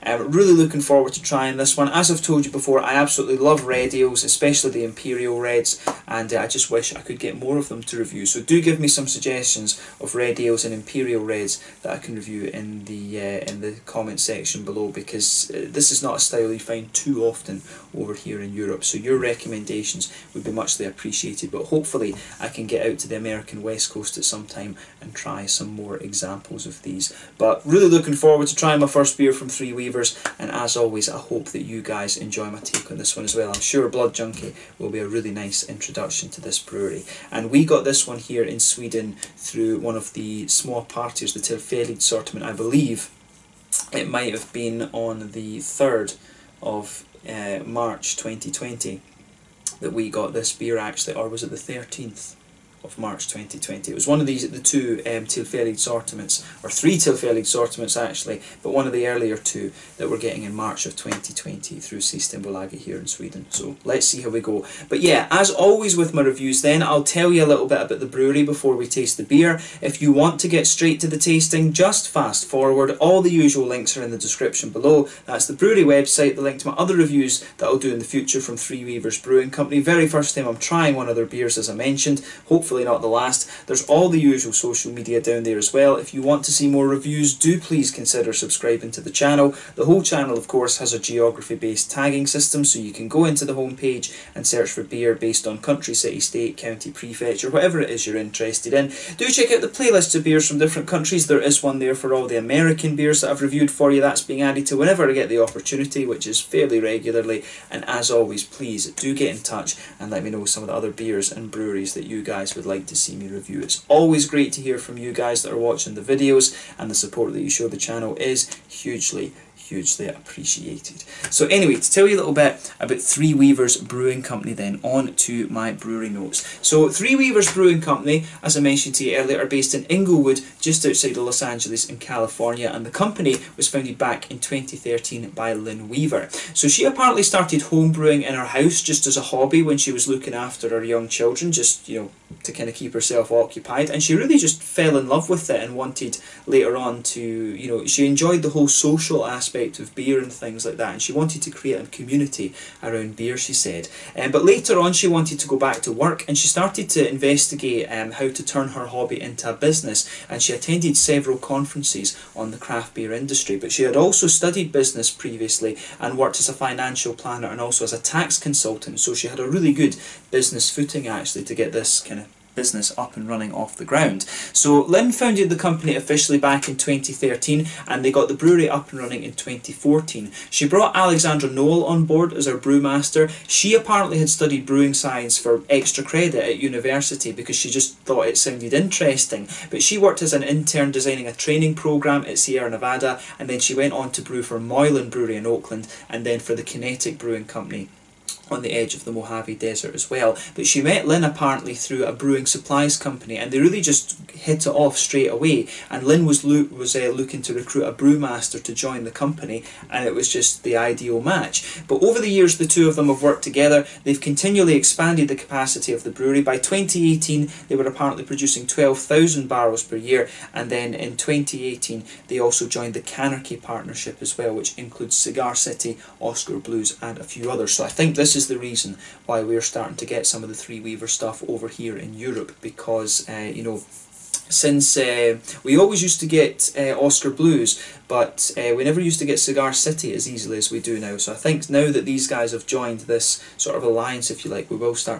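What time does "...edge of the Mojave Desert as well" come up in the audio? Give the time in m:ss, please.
3:18.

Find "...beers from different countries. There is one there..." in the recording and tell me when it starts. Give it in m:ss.
1:40.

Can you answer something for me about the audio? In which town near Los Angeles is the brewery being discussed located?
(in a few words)
Inglewood.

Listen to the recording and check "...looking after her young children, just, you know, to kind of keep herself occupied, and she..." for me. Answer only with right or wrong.
right.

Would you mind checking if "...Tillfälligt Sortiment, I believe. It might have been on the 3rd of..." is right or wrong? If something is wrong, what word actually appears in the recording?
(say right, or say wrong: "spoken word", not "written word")
right.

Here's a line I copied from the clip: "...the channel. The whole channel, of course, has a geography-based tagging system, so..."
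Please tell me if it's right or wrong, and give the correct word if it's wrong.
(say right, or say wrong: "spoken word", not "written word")
right.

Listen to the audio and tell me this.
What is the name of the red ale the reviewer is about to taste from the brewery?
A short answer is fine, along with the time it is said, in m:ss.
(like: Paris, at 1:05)
Blood Junkie, at 0:33.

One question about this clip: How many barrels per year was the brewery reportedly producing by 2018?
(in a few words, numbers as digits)
12,000.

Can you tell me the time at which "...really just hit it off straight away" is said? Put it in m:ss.
3:23.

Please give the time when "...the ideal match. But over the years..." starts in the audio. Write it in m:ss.
3:30.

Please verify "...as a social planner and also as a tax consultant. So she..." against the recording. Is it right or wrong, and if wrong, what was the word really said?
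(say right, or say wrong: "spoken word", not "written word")
wrong: "financial", not "social".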